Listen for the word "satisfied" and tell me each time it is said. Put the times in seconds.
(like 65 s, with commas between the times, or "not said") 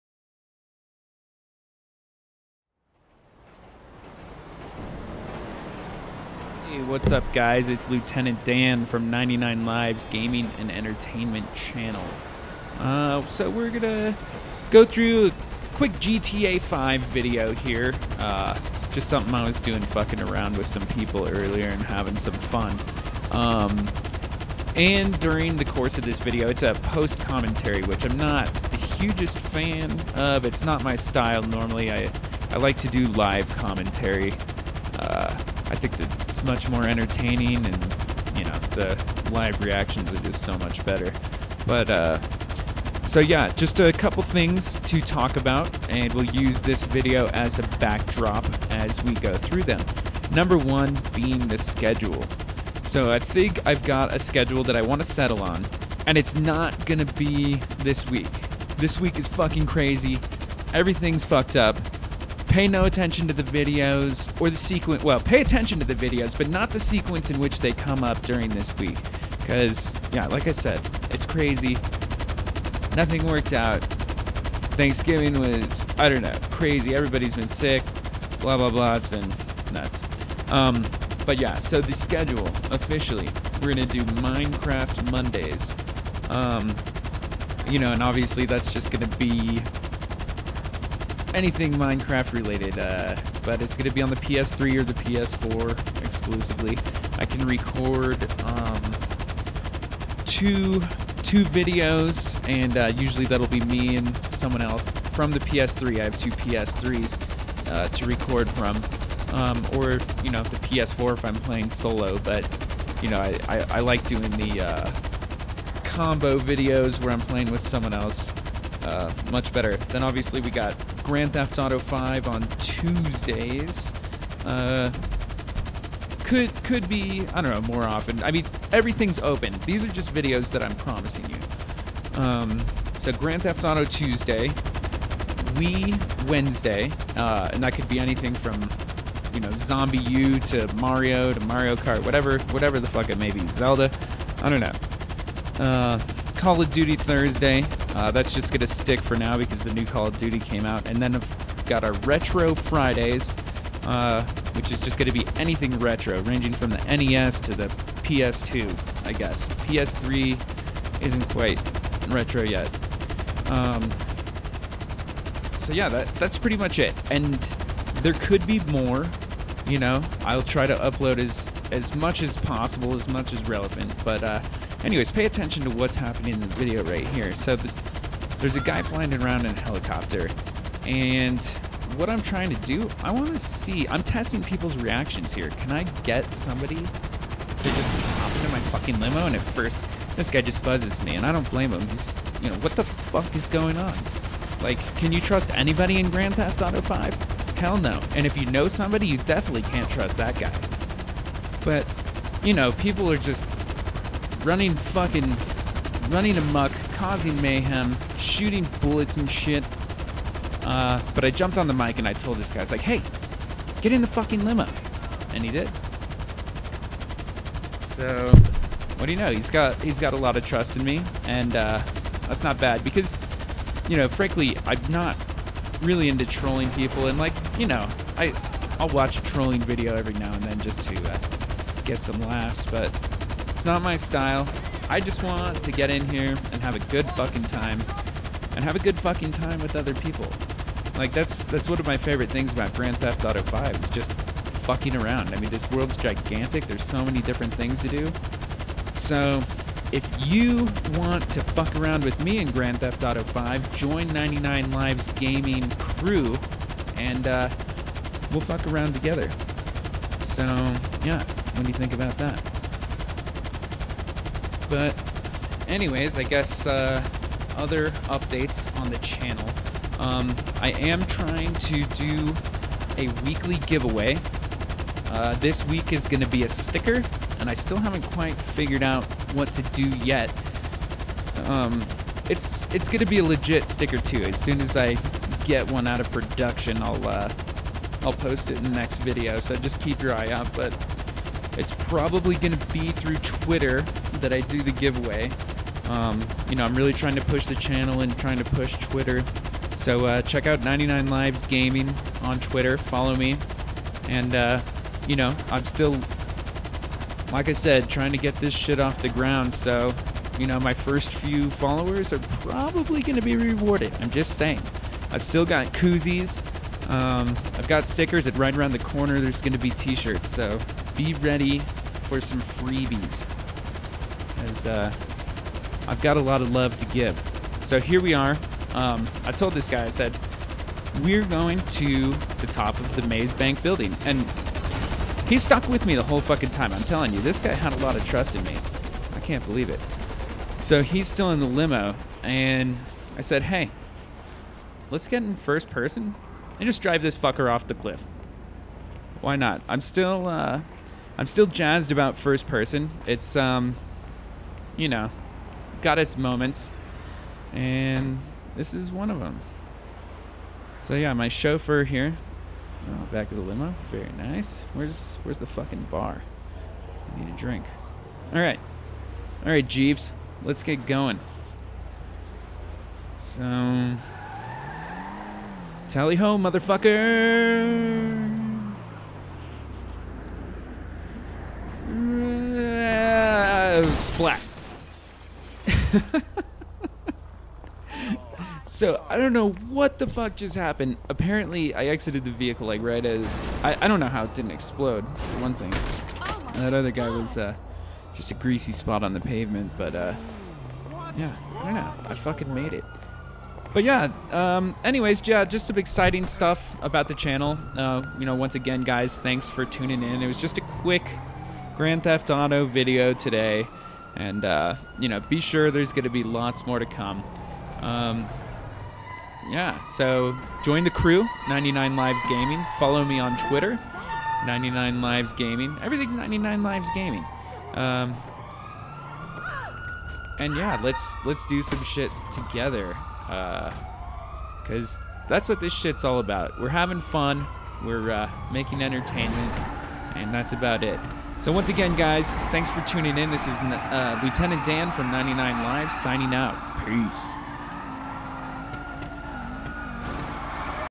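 not said.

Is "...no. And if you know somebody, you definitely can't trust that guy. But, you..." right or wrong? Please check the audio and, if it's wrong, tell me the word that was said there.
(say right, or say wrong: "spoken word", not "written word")
right.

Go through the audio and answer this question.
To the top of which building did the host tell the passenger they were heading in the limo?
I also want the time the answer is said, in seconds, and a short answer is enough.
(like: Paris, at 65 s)
Maze Bank building, at 333 s.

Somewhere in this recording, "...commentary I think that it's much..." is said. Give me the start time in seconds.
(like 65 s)
33 s.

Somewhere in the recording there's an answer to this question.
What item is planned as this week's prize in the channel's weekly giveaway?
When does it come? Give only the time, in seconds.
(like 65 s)
276 s.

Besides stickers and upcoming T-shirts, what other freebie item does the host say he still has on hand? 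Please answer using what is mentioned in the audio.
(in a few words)
Koozies.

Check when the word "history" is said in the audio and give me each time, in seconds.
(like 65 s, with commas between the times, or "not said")
not said.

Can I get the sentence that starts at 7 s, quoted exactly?
It's Lieutenant Dan from 99 Lives Gaming and Entertainment Channel.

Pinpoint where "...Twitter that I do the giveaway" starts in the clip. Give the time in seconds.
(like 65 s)
293 s.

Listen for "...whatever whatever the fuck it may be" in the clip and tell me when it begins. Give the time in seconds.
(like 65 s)
142 s.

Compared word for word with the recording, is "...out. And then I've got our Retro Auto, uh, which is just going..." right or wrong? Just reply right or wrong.
wrong.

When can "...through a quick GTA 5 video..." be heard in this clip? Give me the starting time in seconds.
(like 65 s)
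14 s.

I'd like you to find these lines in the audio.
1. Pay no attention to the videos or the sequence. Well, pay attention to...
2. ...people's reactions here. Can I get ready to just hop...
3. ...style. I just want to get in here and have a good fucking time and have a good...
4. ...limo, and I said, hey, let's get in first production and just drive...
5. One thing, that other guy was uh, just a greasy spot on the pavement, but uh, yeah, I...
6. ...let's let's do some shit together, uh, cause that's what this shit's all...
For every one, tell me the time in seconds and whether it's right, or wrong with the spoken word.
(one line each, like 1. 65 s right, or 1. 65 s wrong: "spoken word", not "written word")
1. 62 s right
2. 184 s wrong: "somebody", not "ready"
3. 233 s right
4. 341 s wrong: "person", not "production"
5. 395 s right
6. 430 s right.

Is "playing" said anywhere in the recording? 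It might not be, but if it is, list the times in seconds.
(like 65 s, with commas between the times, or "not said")
111 s, 117 s.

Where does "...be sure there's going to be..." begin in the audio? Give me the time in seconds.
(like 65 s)
415 s.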